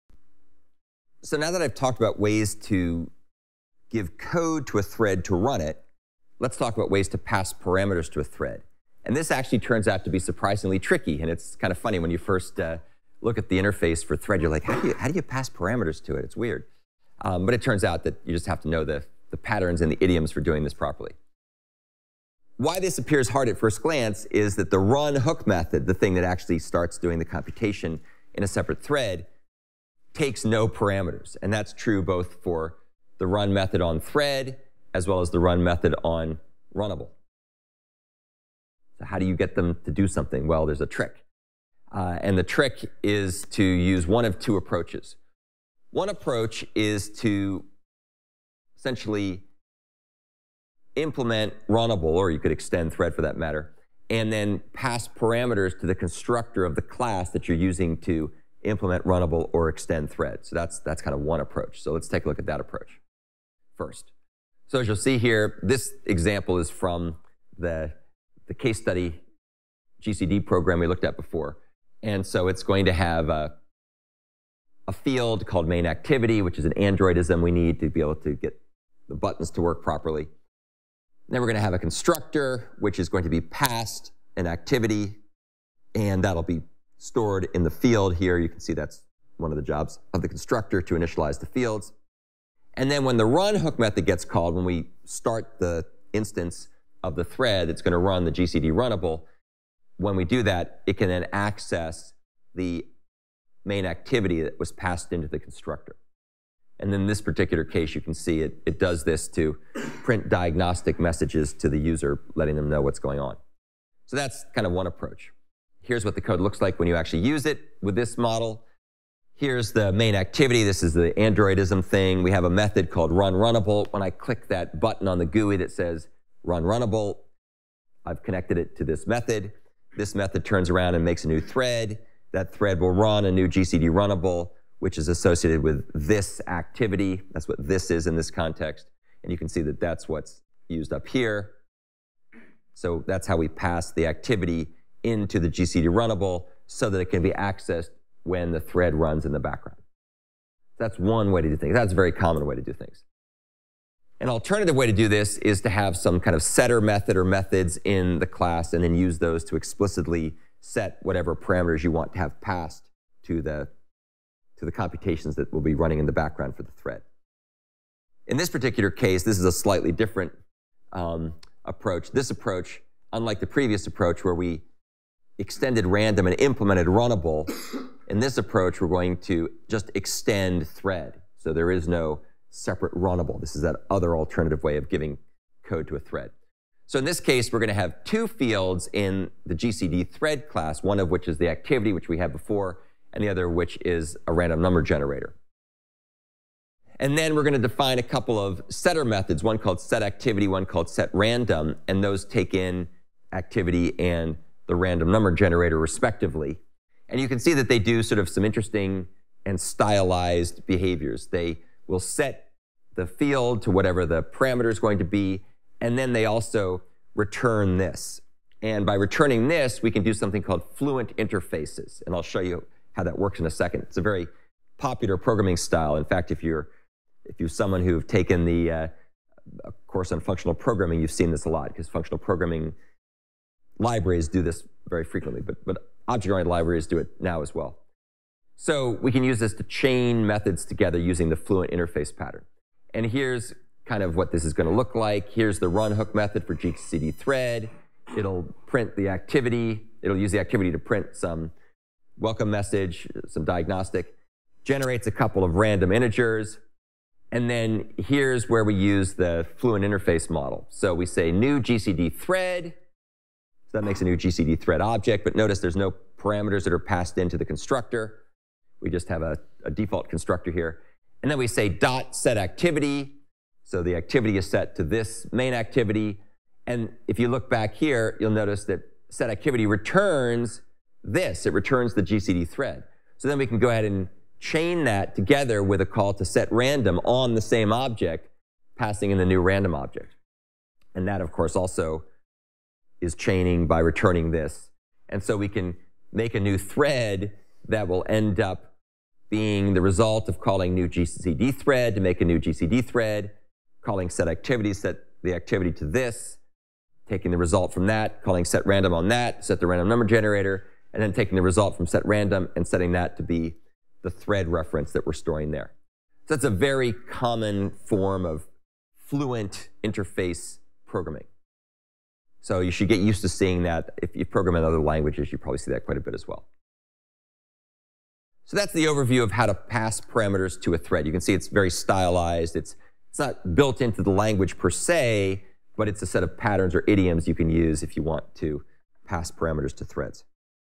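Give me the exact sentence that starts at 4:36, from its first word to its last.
And if you look back here, you'll notice that set activity returns this.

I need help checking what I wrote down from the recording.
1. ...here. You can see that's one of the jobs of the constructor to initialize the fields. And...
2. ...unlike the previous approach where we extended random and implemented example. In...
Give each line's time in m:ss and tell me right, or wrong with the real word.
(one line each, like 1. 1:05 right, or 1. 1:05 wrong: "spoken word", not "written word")
1. 1:28 right
2. 2:53 wrong: "runnable", not "example".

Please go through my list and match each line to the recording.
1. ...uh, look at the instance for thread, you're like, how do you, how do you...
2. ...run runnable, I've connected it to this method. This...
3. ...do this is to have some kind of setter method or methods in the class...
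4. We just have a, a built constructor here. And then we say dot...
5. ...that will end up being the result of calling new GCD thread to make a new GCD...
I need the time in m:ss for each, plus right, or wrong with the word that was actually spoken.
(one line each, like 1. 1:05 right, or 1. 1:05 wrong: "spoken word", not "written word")
1. 0:12 wrong: "interface", not "instance"
2. 2:06 right
3. 2:34 right
4. 4:28 wrong: "default", not "built"
5. 4:57 right.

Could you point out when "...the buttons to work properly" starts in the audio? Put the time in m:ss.
1:19.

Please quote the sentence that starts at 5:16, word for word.
So that's a very common form of fluent interface programming.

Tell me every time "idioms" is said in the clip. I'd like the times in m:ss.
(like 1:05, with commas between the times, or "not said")
0:20, 5:36.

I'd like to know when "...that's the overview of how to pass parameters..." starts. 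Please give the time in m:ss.
5:28.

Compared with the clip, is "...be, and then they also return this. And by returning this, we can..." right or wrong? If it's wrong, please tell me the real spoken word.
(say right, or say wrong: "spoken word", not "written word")
right.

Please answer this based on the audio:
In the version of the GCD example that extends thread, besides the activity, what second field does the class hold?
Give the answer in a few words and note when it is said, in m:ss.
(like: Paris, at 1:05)
a random number generator, at 3:14.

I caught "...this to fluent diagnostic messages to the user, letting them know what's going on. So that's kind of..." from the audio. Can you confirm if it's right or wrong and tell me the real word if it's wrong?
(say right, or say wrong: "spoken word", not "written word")
wrong: "print", not "fluent".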